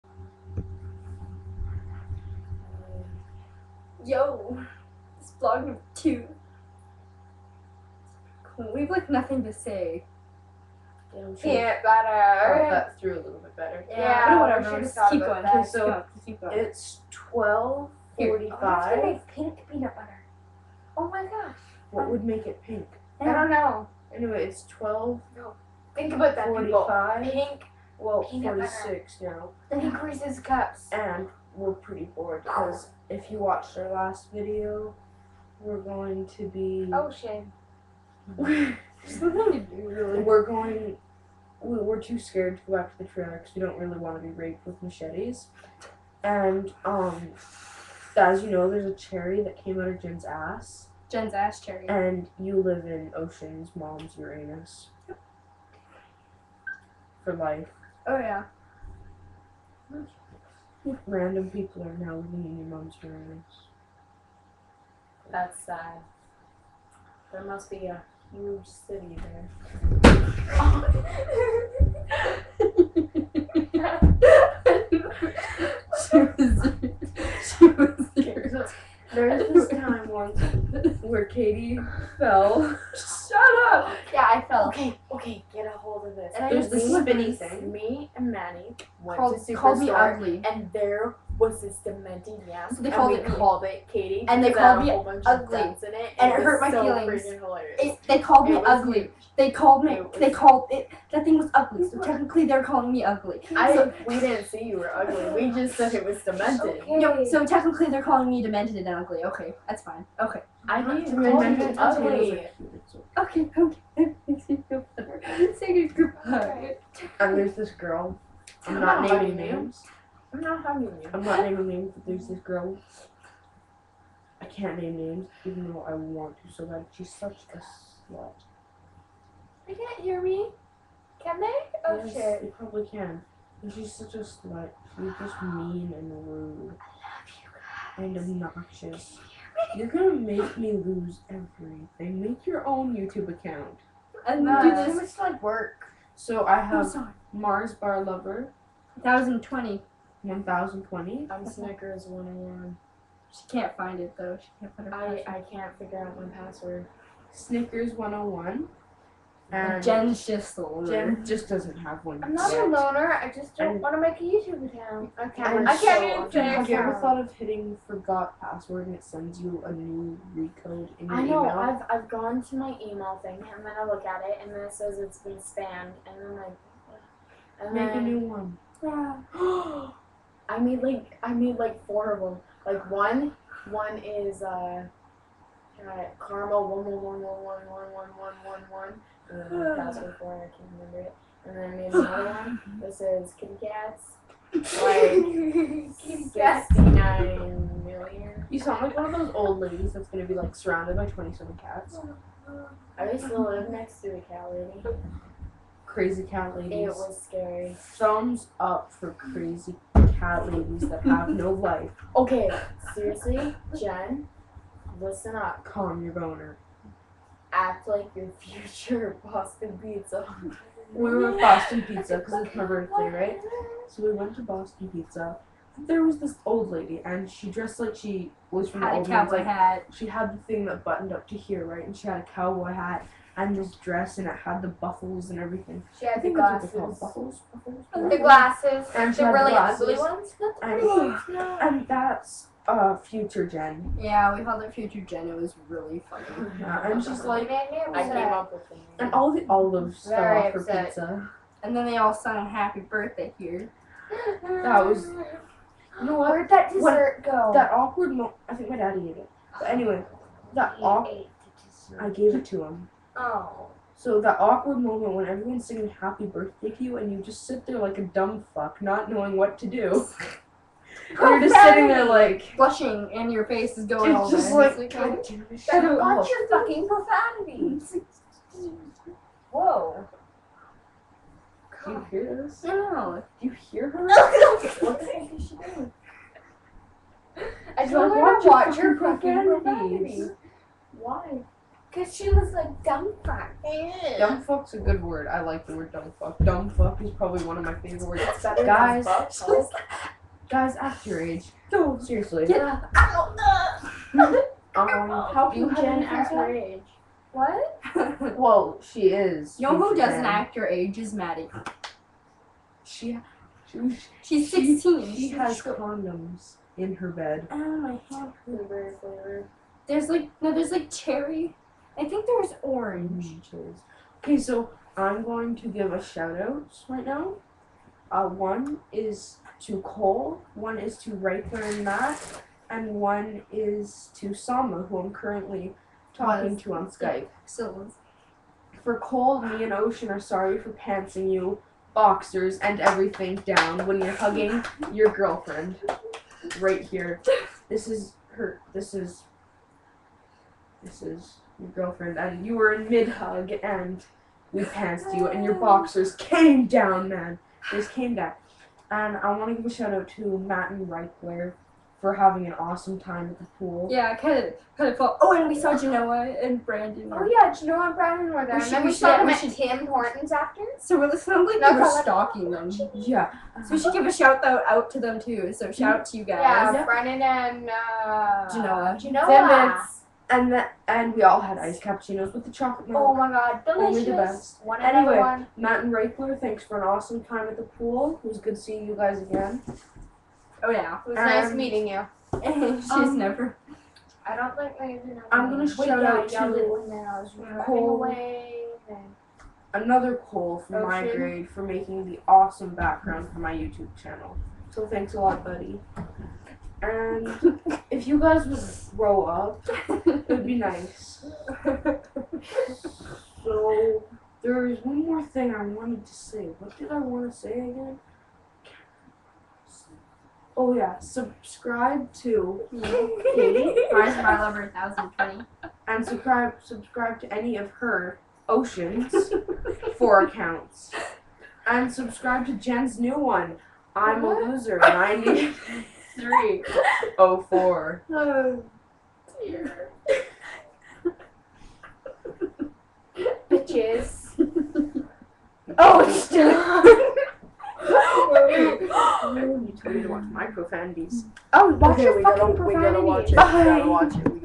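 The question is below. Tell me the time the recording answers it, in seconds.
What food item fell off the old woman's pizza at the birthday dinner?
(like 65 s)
249 s.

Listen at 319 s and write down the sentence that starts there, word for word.
There's like no, there's like cherry.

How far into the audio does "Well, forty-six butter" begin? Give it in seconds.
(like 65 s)
27 s.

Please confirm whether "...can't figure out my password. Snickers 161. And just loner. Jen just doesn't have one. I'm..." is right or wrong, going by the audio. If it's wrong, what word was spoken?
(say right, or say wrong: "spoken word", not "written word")
wrong: "101", not "161".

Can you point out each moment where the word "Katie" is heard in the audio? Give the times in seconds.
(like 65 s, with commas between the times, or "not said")
93 s, 423 s.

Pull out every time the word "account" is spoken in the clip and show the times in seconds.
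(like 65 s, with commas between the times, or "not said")
143 s, 164 s, 430 s.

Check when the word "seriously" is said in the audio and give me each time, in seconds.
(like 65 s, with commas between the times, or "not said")
212 s, 301 s.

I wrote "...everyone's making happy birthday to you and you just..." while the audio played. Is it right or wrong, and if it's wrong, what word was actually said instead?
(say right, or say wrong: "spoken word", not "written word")
wrong: "singing", not "making".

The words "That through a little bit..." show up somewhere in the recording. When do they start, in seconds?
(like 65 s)
12 s.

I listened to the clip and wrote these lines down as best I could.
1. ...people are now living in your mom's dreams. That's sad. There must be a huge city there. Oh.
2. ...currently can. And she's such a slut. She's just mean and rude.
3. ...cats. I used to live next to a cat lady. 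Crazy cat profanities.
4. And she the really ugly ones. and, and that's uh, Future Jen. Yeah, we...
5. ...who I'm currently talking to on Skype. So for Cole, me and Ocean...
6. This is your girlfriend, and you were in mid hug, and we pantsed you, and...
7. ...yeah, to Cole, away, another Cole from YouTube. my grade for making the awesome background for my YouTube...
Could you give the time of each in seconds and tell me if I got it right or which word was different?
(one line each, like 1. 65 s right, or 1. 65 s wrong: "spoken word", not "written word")
1. 61 s right
2. 132 s wrong: "probably", not "currently"
3. 201 s wrong: "ladies", not "profanities"
4. 238 s right
5. 334 s right
6. 350 s right
7. 396 s wrong: "Ocean", not "YouTube".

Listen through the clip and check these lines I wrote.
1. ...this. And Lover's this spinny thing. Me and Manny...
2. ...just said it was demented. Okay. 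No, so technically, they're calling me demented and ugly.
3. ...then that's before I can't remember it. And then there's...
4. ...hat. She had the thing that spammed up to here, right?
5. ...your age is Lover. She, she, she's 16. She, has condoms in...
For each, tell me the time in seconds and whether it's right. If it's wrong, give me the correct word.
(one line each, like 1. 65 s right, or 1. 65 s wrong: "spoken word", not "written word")
1. 86 s wrong: "There", not "Lover"
2. 105 s right
3. 189 s right
4. 229 s wrong: "buttoned", not "spammed"
5. 310 s wrong: "Maddie", not "Lover".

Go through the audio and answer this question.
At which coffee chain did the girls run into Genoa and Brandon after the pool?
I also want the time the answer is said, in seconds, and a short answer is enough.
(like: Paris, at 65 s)
Tim Hortons, at 368 s.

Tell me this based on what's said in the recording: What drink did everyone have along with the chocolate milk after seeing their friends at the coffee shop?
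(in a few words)
iced cappuccinos.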